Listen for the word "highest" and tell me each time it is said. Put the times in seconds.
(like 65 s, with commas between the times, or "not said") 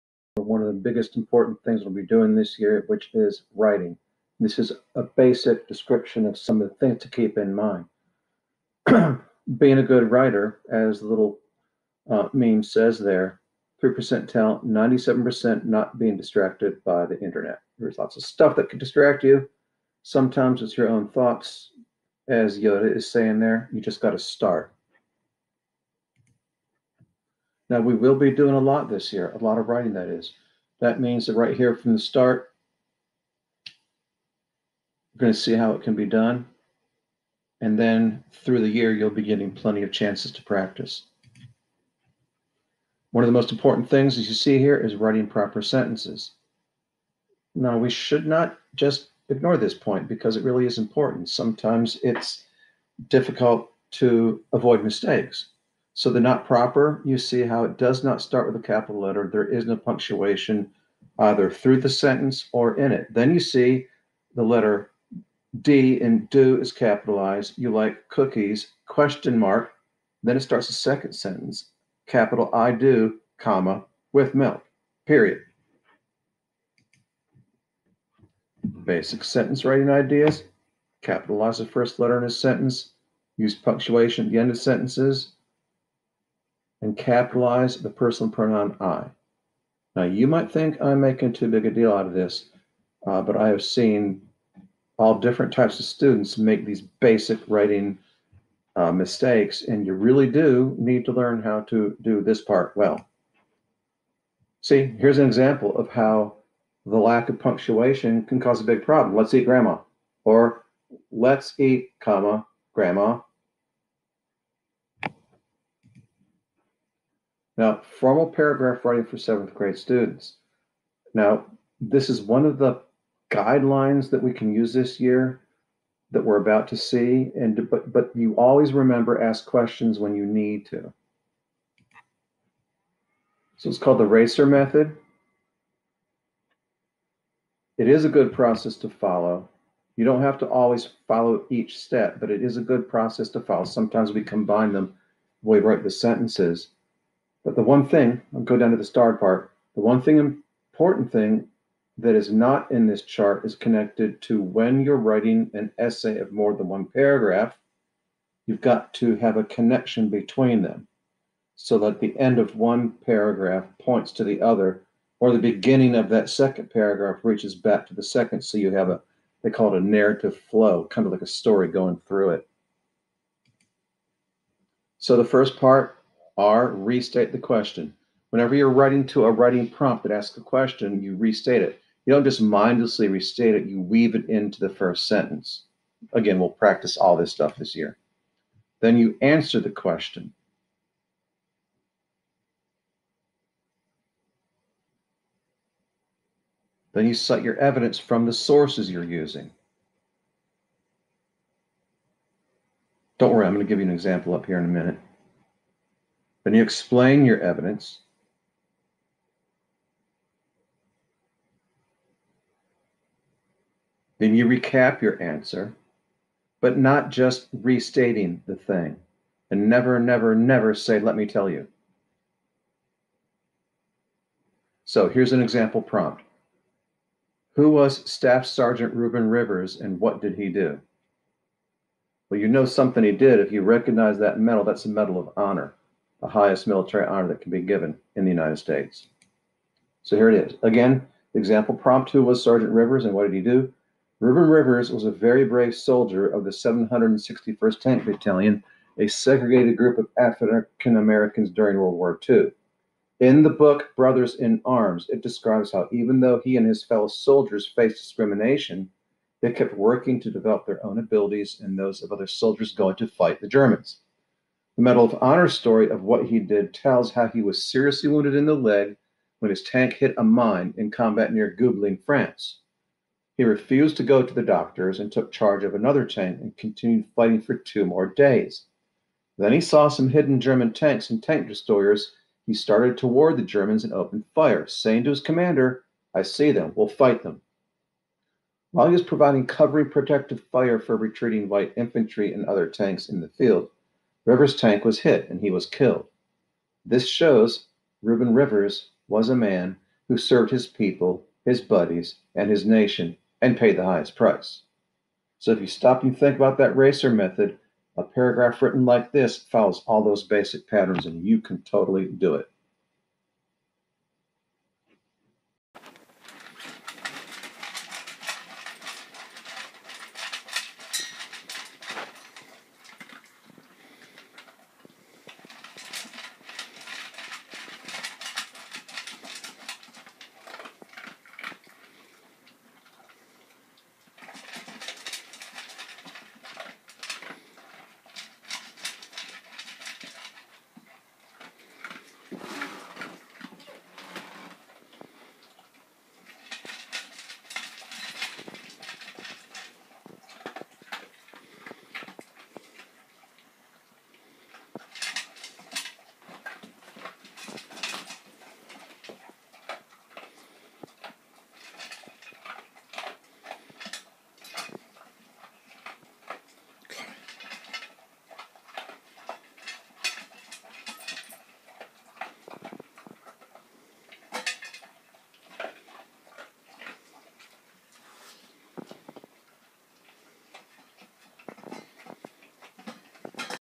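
236 s, 303 s.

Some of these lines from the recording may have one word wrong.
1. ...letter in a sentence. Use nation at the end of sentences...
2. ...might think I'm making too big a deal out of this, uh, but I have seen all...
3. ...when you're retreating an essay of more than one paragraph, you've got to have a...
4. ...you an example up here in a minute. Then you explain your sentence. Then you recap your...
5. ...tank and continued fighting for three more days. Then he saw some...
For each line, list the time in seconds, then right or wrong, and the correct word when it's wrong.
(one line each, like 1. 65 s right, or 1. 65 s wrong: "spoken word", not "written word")
1. 81 s wrong: "punctuation", not "nation"
2. 90 s right
3. 154 s wrong: "writing", not "retreating"
4. 203 s wrong: "evidence", not "sentence"
5. 276 s wrong: "two", not "three".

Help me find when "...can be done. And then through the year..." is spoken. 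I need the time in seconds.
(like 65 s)
35 s.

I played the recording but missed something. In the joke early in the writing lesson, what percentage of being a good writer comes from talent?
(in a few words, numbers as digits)
3%.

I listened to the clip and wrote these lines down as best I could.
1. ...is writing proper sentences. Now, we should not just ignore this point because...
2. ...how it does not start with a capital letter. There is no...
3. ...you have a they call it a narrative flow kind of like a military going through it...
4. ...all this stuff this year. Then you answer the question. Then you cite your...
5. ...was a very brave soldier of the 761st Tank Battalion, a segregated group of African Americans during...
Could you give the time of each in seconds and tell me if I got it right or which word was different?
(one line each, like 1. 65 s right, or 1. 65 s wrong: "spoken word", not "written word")
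1. 44 s right
2. 57 s right
3. 168 s wrong: "story", not "military"
4. 186 s right
5. 244 s right.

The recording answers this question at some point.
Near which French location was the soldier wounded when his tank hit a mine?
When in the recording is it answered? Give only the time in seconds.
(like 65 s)
271 s.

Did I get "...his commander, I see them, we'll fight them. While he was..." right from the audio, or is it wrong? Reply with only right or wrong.
right.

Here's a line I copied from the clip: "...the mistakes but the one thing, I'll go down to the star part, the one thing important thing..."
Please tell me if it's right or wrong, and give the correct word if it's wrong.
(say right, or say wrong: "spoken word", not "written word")
wrong: "sentences", not "mistakes".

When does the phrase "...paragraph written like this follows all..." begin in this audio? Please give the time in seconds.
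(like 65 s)
308 s.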